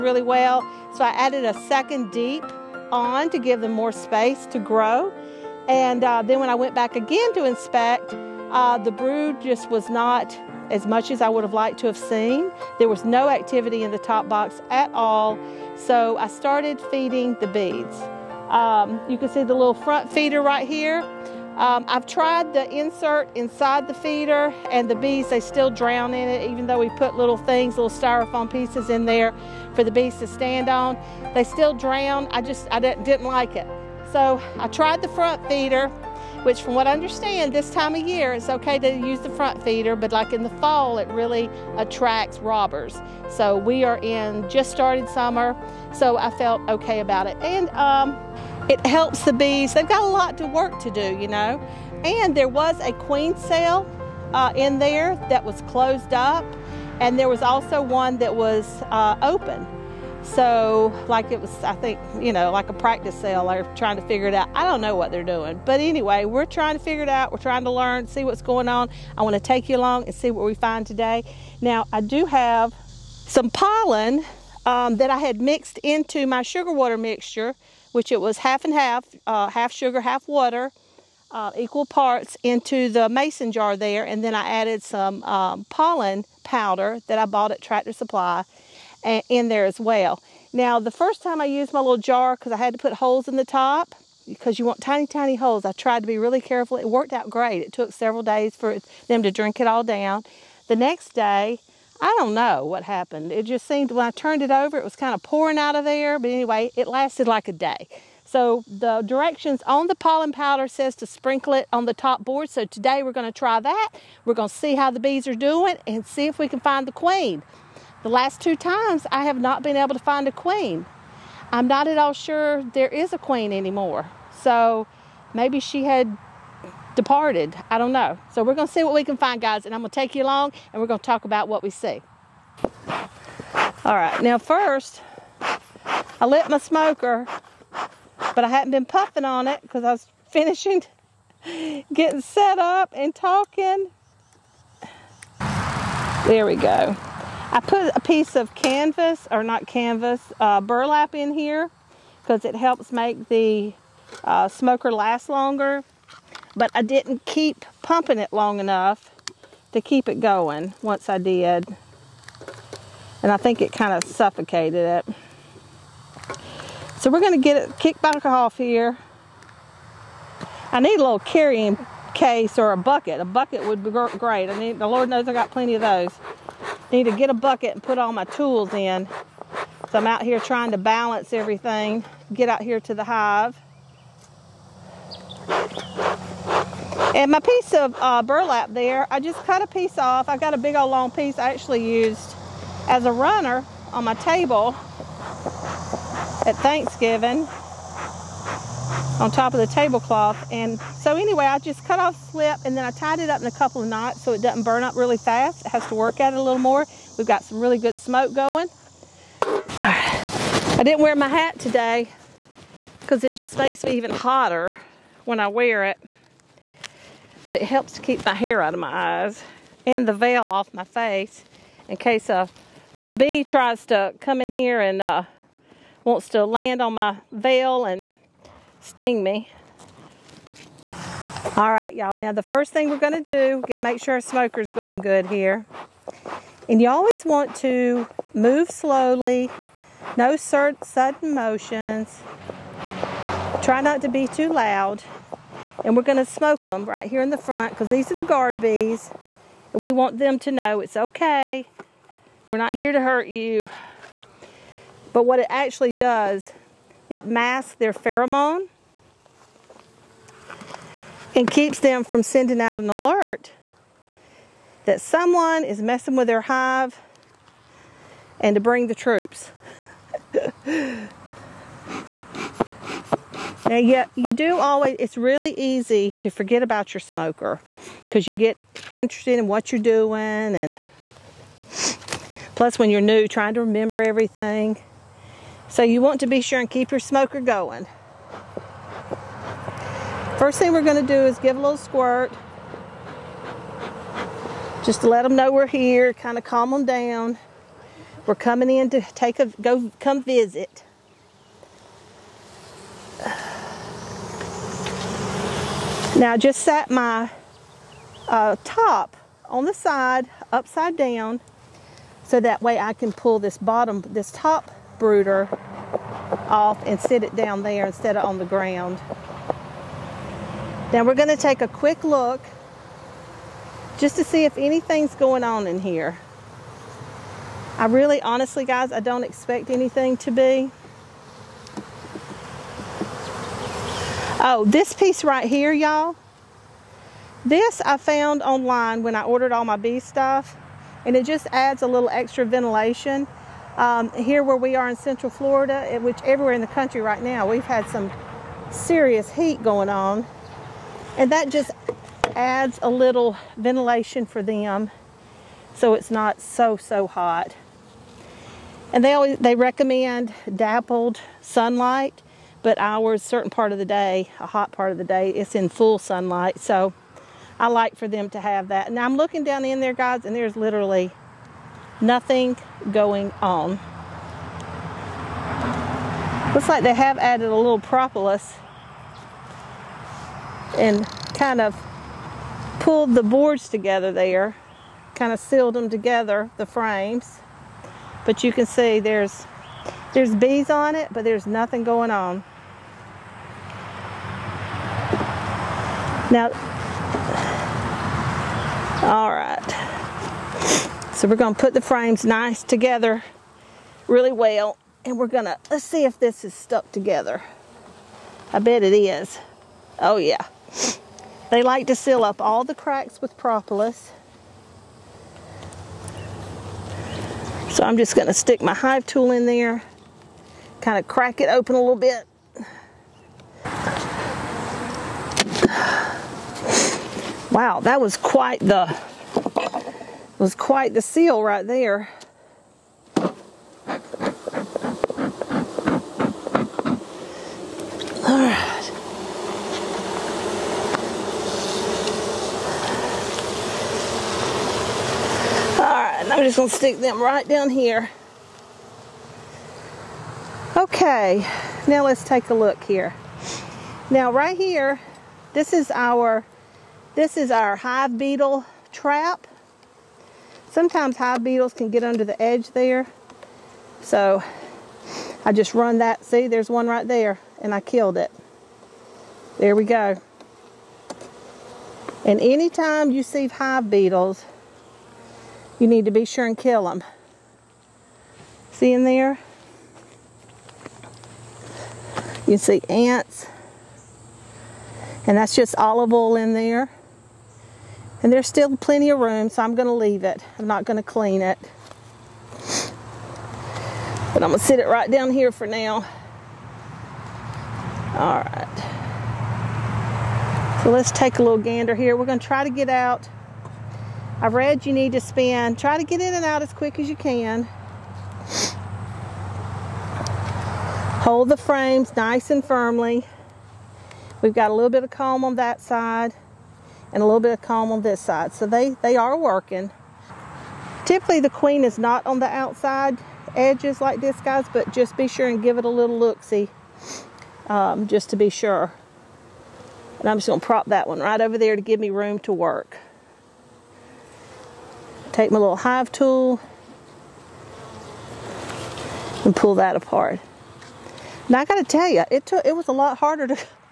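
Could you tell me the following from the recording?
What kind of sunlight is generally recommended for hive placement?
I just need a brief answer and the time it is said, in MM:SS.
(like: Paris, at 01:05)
dappled sunlight, at 06:00.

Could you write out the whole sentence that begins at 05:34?
Oh, this piece right here, y'all.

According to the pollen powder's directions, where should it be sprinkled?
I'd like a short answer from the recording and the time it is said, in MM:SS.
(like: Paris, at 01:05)
the top board, at 01:51.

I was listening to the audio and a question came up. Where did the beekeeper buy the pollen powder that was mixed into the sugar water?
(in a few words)
Tractor Supply.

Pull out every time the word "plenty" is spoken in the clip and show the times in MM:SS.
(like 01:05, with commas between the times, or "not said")
02:55, 08:08.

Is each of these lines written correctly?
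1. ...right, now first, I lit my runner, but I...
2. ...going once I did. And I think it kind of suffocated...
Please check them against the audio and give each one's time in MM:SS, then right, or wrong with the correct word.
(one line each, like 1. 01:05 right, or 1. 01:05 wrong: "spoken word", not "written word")
1. 02:13 wrong: "smoker", not "runner"
2. 02:40 right.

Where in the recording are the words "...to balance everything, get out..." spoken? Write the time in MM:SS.
03:00.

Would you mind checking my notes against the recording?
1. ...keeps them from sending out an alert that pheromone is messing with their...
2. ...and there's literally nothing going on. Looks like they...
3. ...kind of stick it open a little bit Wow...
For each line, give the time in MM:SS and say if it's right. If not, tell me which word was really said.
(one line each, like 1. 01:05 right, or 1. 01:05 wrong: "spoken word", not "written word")
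1. 04:21 wrong: "someone", not "pheromone"
2. 06:10 right
3. 07:00 wrong: "crack", not "stick".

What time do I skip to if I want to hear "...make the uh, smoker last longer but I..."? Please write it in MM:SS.
02:32.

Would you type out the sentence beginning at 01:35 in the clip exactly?
I tried to be really careful.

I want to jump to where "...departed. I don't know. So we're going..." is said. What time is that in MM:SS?
02:06.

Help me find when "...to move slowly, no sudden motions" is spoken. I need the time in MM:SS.
03:57.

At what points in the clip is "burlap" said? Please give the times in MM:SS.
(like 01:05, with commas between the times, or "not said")
02:30, 03:08.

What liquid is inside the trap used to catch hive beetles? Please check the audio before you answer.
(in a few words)
olive oil.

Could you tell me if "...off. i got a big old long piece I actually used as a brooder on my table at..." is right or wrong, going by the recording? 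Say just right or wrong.
wrong.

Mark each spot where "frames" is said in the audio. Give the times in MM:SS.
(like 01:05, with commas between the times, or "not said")
06:26, 06:41, 08:31.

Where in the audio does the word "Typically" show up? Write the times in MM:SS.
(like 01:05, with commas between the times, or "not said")
08:41.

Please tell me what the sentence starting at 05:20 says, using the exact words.
Now we're going to take a quick look just to see if anything's going on in here.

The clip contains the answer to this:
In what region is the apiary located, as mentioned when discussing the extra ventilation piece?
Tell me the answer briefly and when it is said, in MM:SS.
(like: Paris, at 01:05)
Central Florida, at 05:44.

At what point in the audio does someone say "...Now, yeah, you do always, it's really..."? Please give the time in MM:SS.
04:33.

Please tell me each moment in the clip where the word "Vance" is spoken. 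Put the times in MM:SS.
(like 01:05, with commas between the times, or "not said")
not said.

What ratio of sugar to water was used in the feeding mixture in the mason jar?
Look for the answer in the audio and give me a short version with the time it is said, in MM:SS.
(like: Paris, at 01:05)
half and half, at 01:18.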